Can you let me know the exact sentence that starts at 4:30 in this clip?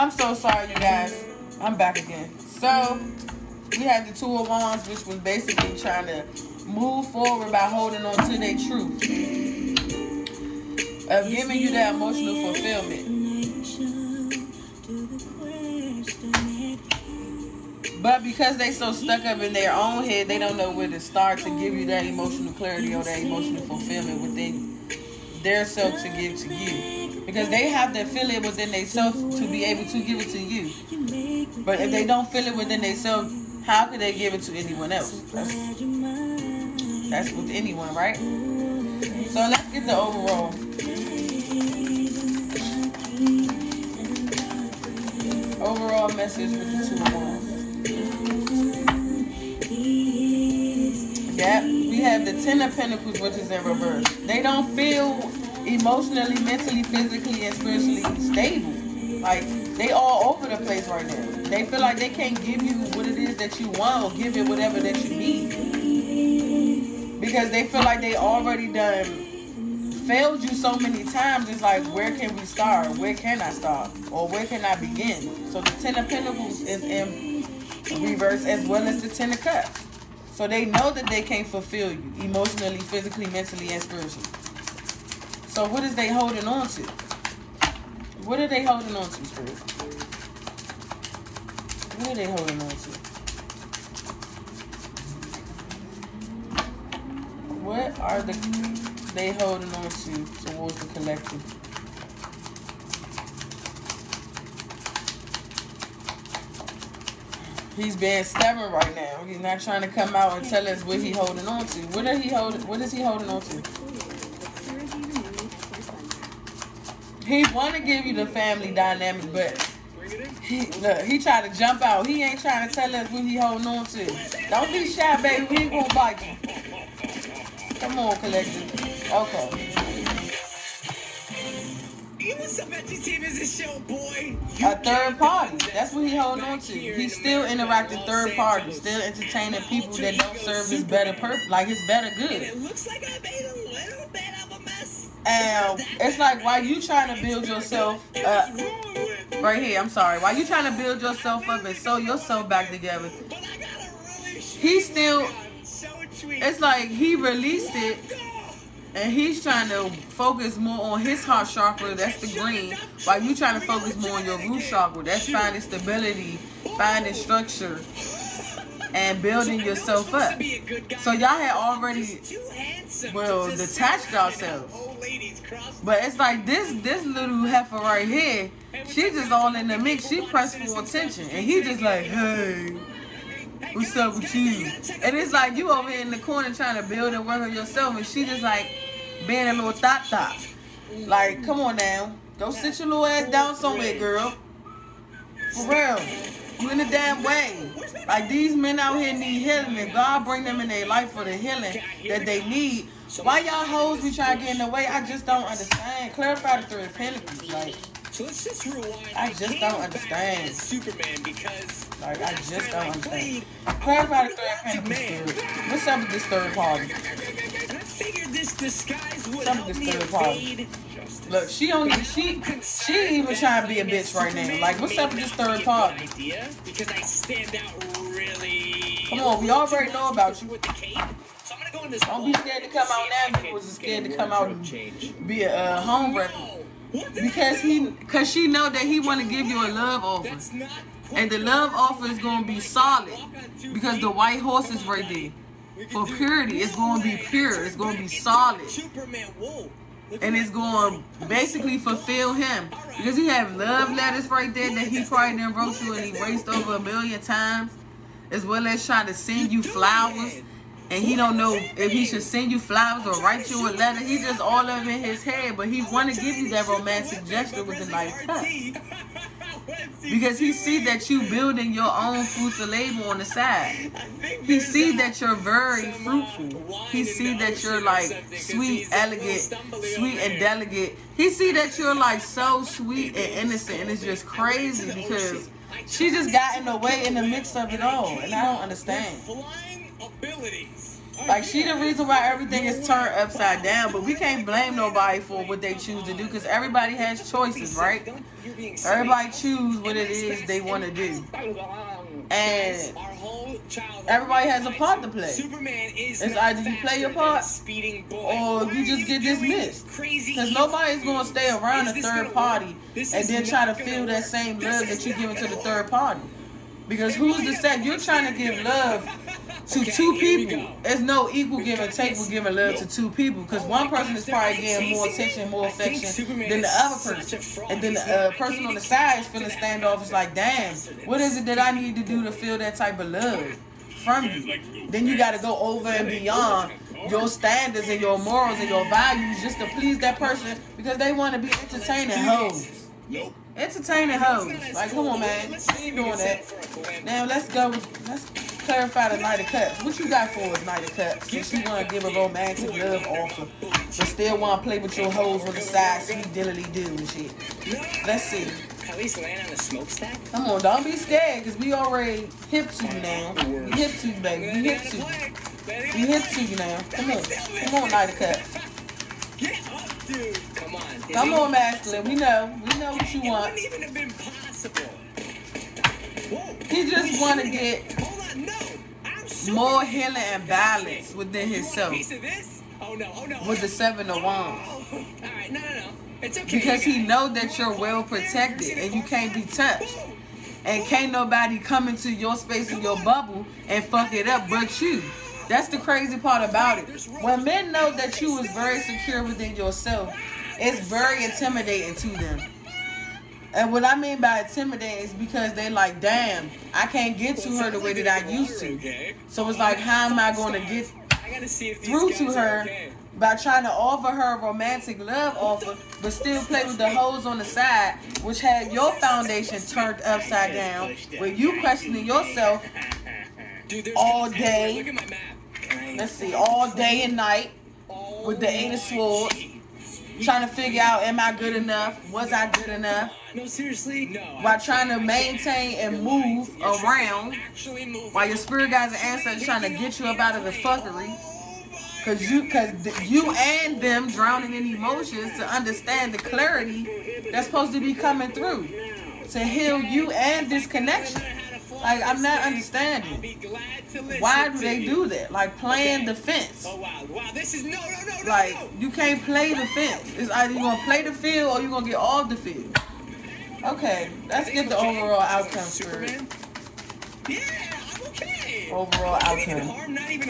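Because he see that you building your own food to label on the side.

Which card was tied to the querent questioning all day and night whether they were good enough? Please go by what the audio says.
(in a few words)
Eight of Swords.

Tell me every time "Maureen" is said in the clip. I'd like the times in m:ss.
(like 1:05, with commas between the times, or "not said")
not said.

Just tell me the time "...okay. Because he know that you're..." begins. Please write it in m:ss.
6:26.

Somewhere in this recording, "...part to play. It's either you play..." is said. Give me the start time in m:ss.
5:04.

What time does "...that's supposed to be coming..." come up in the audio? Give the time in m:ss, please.
7:27.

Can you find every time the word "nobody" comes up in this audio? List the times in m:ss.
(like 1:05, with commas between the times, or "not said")
4:54, 5:10, 6:31.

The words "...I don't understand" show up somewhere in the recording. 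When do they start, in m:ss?
4:48.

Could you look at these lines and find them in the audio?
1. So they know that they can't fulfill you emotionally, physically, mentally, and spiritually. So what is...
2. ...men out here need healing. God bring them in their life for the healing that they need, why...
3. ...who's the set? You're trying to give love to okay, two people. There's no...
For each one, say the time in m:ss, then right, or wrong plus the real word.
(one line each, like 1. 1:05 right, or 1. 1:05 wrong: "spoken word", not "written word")
1. 1:20 right
2. 3:18 right
3. 5:17 right.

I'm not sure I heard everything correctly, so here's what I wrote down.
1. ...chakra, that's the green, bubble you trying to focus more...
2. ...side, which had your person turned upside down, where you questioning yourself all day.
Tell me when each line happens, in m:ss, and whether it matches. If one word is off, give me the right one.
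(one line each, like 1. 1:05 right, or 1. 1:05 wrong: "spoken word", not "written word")
1. 2:41 wrong: "while", not "bubble"
2. 6:57 wrong: "foundation", not "person".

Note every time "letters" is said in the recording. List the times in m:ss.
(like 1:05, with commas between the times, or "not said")
4:13, 4:23.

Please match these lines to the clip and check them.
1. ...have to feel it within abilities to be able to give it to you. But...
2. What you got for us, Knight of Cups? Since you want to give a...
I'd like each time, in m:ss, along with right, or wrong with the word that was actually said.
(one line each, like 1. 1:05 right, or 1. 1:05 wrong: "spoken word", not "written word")
1. 0:27 wrong: "themselves", not "abilities"
2. 5:49 right.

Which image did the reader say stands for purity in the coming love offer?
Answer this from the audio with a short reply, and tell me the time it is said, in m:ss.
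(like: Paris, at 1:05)
white horse, at 4:04.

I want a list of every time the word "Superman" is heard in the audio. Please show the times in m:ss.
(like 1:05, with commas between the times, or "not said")
3:30, 7:45.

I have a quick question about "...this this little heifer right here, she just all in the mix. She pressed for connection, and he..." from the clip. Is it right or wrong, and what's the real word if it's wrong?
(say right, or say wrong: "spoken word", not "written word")
wrong: "attention", not "connection".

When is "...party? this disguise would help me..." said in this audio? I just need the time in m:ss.
3:36.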